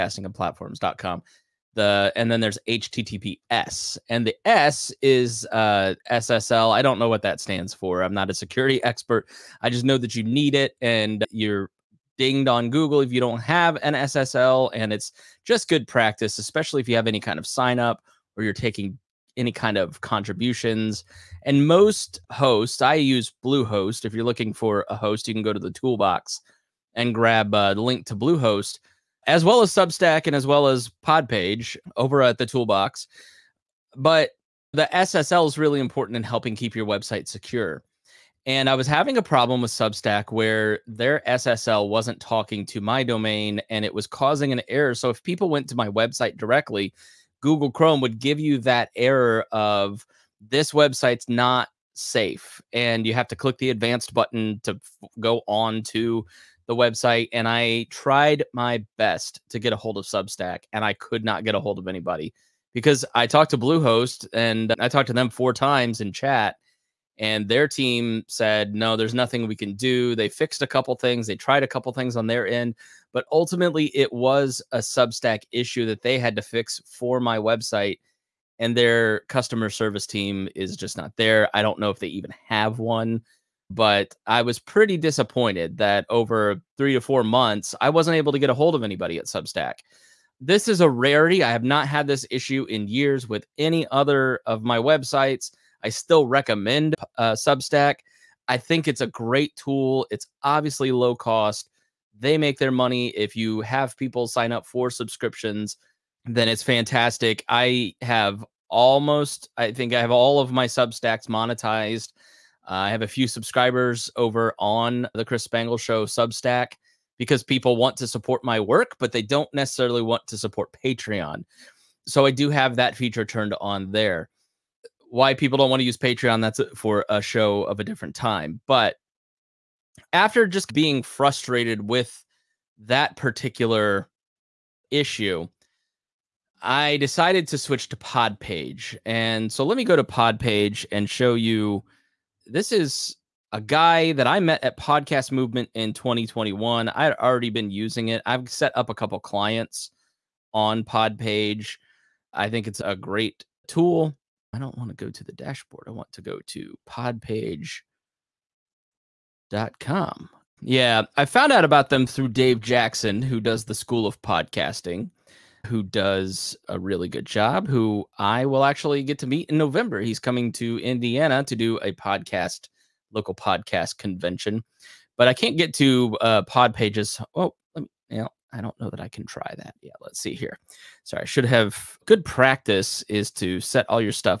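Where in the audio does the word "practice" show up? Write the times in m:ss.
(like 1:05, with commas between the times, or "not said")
0:15, 3:02.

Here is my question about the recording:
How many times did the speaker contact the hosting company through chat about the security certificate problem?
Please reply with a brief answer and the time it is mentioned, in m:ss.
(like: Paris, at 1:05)
4, at 1:05.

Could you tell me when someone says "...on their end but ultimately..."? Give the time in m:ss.
1:12.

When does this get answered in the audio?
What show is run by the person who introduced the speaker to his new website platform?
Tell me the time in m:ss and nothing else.
2:43.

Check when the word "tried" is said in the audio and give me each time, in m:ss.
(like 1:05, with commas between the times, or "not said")
0:57, 1:11.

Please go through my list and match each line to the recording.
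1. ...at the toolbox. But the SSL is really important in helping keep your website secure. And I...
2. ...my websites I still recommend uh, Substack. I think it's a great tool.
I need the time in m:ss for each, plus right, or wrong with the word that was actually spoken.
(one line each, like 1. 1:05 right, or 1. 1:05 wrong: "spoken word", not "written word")
1. 0:32 right
2. 1:34 right.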